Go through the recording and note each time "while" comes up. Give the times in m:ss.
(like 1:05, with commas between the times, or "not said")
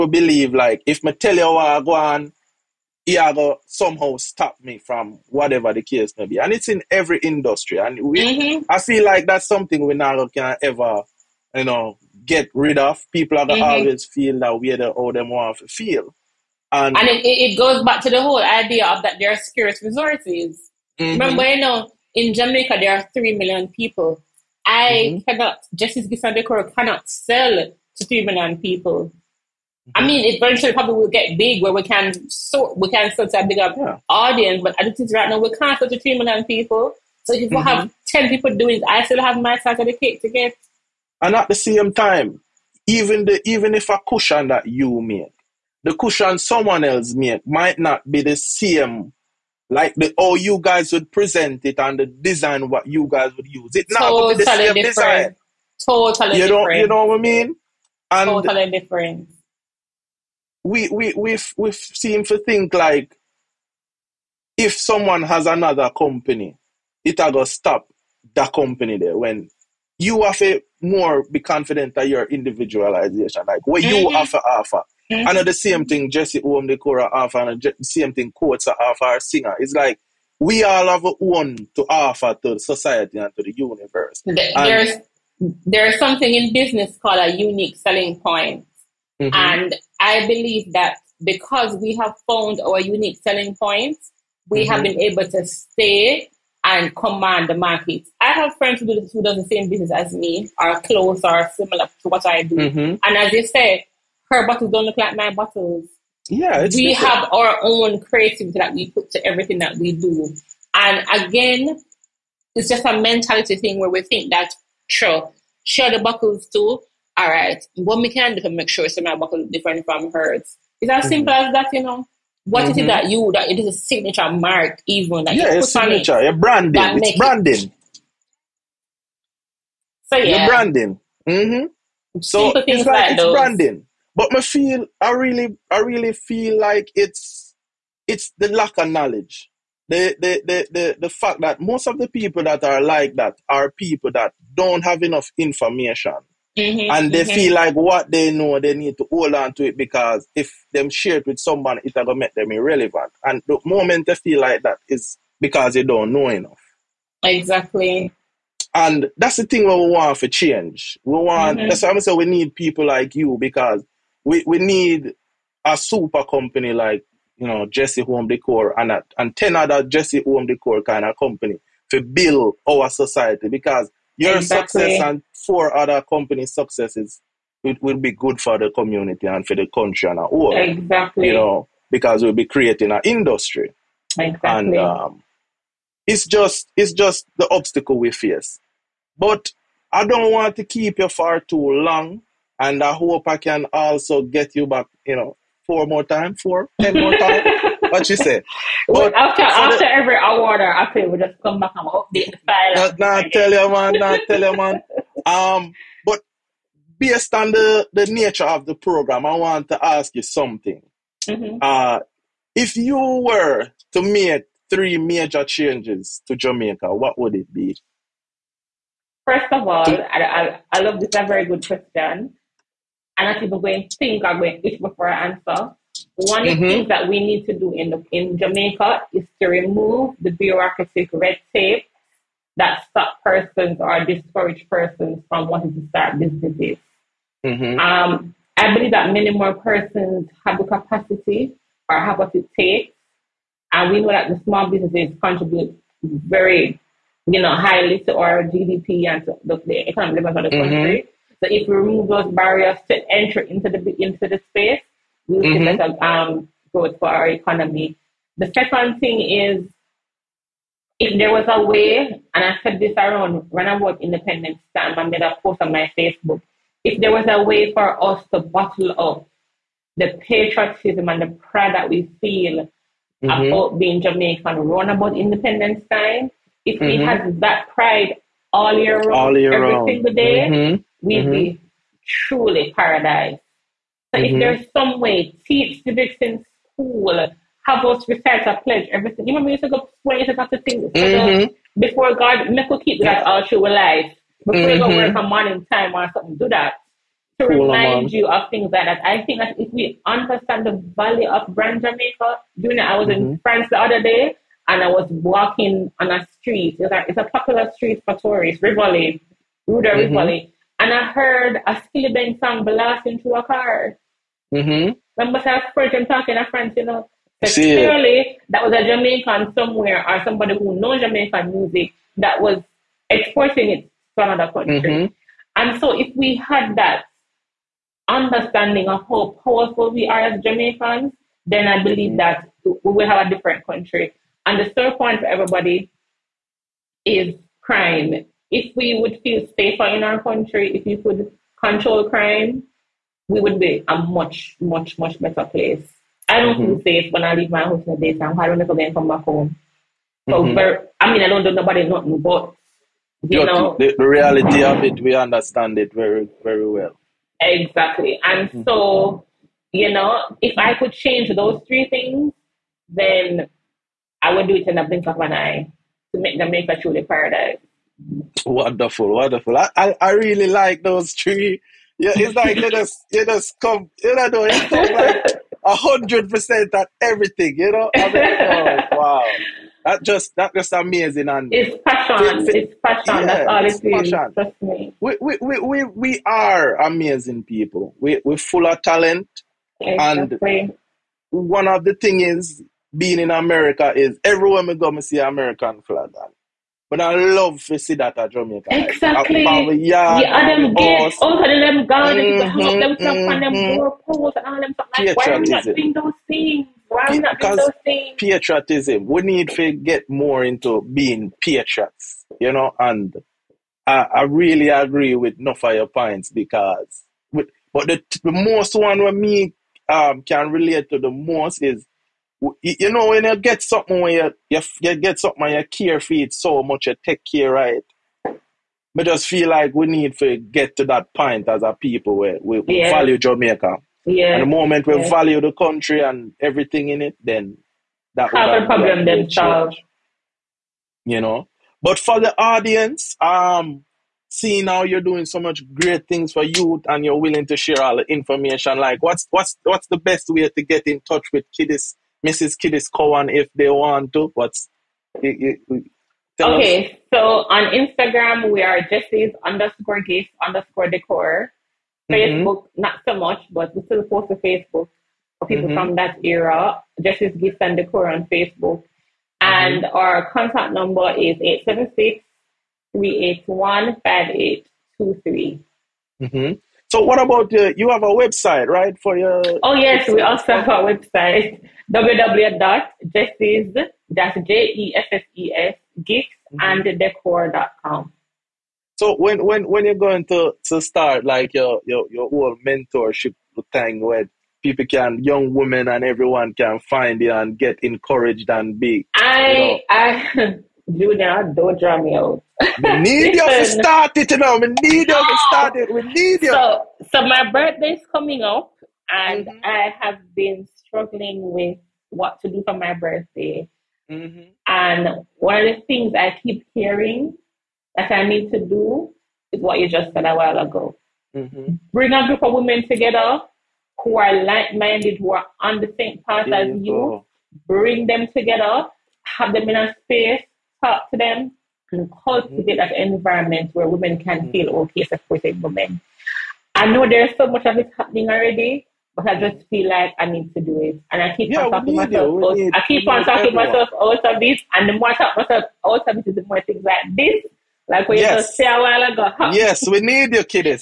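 8:40, 9:08.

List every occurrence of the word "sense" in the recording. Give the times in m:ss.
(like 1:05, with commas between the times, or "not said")
not said.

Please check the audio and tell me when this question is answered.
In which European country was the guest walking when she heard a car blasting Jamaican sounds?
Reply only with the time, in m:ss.
5:03.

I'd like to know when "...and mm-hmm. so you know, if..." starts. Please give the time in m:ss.
5:58.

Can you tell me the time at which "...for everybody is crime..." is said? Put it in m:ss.
5:35.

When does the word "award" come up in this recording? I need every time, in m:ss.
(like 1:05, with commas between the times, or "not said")
3:20.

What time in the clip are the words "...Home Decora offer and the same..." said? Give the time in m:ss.
1:16.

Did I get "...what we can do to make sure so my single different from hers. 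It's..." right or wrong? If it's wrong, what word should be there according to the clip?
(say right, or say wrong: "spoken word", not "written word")
wrong: "bottle", not "single".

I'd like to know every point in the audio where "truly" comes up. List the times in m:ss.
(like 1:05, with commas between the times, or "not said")
4:42, 6:06.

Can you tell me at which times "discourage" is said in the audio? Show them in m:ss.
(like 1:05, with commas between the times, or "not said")
3:54.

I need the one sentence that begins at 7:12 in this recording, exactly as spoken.
value Jamaica yeah and the moment we yeah.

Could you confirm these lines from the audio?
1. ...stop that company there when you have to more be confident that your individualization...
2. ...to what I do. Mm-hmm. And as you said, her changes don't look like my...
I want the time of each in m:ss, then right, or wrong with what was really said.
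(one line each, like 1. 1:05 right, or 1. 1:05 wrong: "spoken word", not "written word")
1. 1:07 right
2. 1:42 wrong: "bottles", not "changes".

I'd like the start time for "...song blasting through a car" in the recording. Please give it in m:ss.
5:12.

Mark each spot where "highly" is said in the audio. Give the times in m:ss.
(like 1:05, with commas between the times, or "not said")
4:07.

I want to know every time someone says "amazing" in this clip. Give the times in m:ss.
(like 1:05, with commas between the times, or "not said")
6:20, 6:26.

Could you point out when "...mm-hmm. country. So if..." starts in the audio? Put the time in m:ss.
4:10.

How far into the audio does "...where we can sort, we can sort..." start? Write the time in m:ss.
0:31.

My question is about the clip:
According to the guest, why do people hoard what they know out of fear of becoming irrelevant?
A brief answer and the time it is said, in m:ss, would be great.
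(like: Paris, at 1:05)
lack of knowledge, at 2:18.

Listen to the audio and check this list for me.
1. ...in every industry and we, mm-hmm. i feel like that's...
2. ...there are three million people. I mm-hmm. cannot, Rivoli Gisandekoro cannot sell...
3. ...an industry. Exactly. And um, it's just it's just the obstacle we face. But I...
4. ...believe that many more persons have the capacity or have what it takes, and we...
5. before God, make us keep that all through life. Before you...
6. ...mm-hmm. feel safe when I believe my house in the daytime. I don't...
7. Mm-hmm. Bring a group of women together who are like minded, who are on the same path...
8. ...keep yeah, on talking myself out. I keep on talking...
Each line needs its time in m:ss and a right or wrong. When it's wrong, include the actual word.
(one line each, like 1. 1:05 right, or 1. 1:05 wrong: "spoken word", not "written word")
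1. 0:06 right
2. 0:22 wrong: "Justice", not "Rivoli"
3. 3:02 right
4. 3:58 right
5. 4:51 right
6. 5:46 wrong: "leave", not "believe"
7. 8:41 right
8. 9:01 right.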